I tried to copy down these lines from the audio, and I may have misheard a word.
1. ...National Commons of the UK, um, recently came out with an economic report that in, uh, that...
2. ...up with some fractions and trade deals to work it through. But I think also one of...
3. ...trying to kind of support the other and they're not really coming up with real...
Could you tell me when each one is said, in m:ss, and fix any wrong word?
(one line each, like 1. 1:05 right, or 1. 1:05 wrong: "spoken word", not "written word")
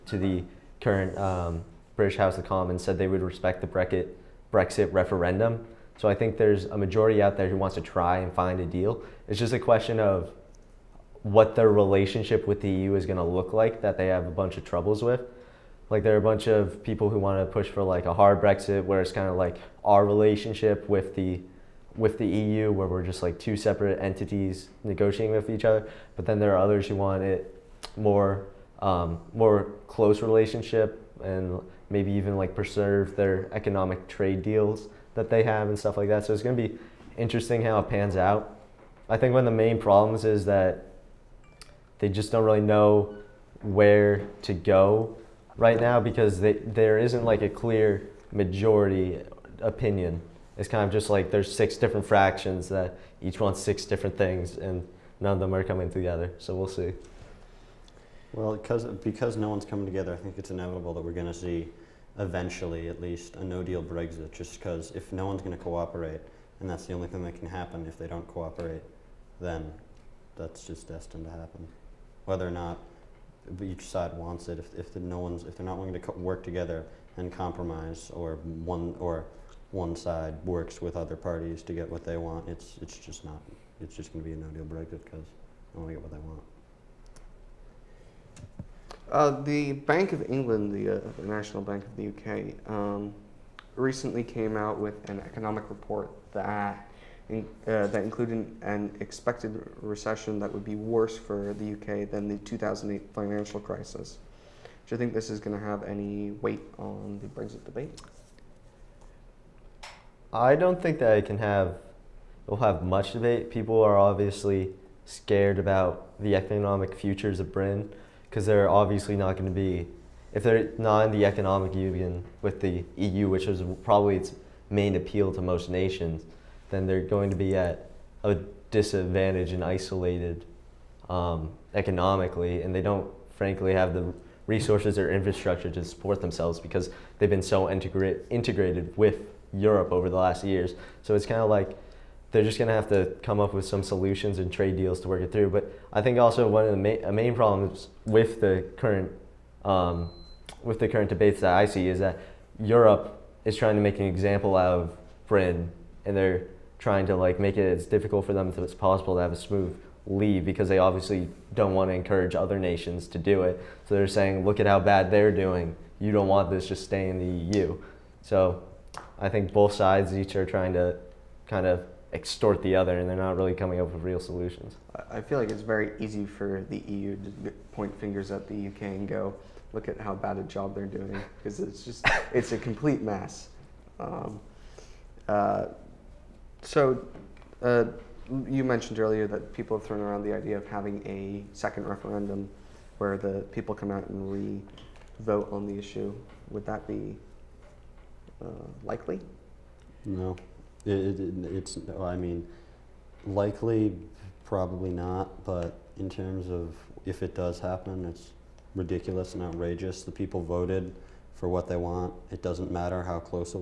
1. 1:31 wrong: "Bank", not "Commons"
2. 2:23 wrong: "solutions", not "fractions"
3. 2:50 wrong: "extort", not "support".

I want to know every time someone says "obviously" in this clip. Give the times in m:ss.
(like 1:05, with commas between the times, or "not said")
1:53, 1:58, 2:40.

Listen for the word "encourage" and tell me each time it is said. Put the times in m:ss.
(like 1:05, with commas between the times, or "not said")
2:41.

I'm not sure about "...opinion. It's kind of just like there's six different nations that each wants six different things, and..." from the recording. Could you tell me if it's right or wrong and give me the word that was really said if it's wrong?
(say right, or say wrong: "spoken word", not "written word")
wrong: "fractions", not "nations".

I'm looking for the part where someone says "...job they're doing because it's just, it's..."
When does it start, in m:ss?
3:00.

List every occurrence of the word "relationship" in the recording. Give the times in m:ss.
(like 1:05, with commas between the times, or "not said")
0:11, 0:20, 0:30.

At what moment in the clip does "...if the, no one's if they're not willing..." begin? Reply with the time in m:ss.
1:14.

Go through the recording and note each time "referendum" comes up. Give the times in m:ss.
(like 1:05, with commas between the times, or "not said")
0:04, 3:11.